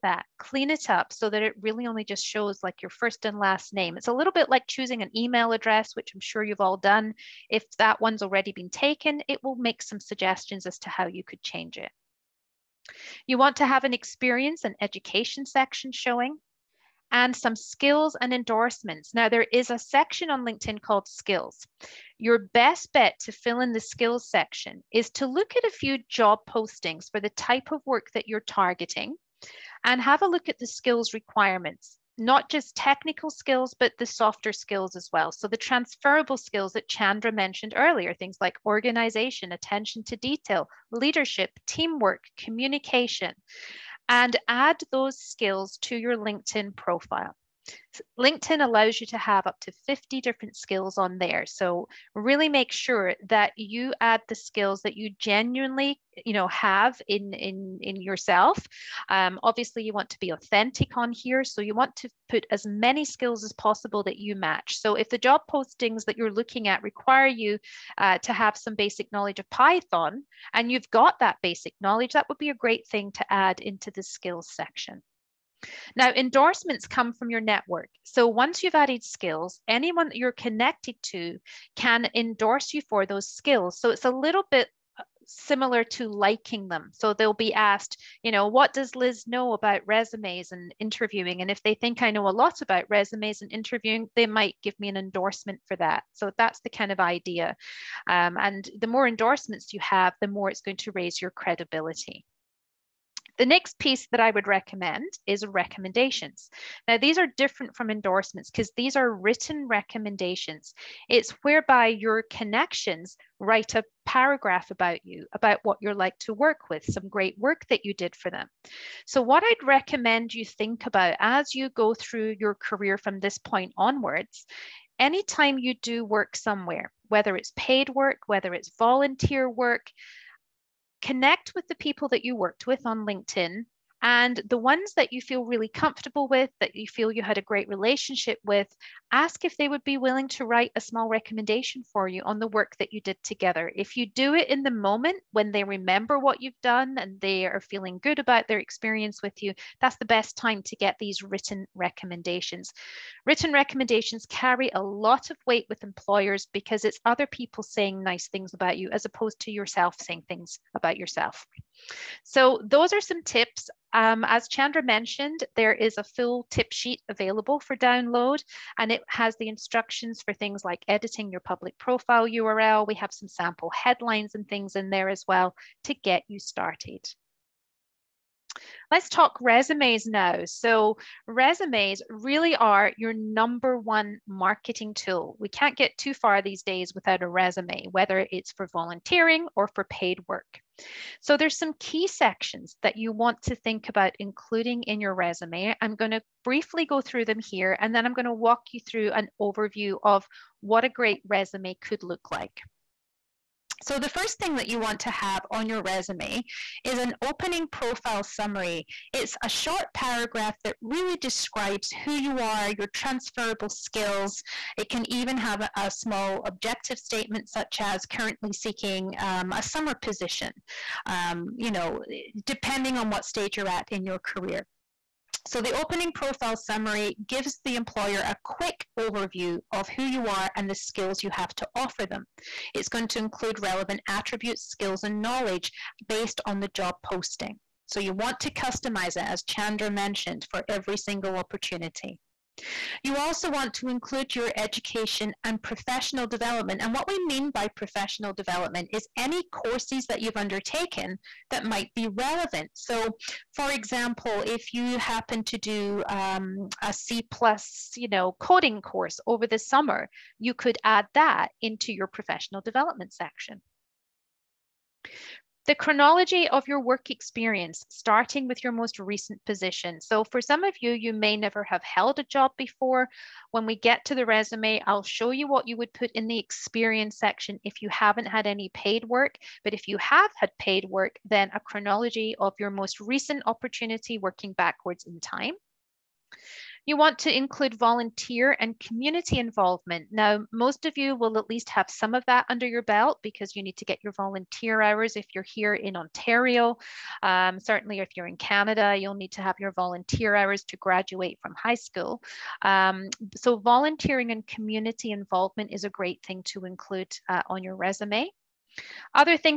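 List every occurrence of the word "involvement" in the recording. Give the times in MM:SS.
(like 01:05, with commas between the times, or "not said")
04:49, 05:05.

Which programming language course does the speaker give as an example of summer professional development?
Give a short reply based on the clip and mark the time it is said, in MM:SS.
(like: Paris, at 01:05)
C plus, at 04:16.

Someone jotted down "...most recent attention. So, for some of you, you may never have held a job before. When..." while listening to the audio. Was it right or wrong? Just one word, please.
wrong.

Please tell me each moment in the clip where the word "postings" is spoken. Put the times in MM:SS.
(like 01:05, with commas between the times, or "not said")
00:26, 01:05, 03:57.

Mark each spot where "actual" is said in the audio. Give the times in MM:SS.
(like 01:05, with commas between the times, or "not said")
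not said.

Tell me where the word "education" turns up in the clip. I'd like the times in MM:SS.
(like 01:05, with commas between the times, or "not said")
00:14, 04:04.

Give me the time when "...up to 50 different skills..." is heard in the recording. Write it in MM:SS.
00:49.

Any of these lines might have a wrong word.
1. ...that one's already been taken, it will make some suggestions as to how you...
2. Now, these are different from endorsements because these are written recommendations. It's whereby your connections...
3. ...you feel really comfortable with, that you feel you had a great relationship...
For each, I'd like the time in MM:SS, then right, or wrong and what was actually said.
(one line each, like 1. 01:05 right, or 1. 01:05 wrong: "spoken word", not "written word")
1. 00:07 right
2. 01:46 right
3. 02:15 right.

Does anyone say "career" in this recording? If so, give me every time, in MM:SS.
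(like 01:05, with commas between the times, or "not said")
02:02, 03:44.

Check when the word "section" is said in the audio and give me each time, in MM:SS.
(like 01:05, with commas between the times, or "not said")
00:15, 00:19, 00:24, 01:14, 03:12, 04:23, 04:37.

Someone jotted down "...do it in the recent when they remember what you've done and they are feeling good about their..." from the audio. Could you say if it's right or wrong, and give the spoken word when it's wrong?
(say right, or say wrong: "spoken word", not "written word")
wrong: "moment", not "recent".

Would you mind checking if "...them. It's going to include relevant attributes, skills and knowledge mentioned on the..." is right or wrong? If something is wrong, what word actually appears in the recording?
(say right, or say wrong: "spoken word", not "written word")
wrong: "based", not "mentioned".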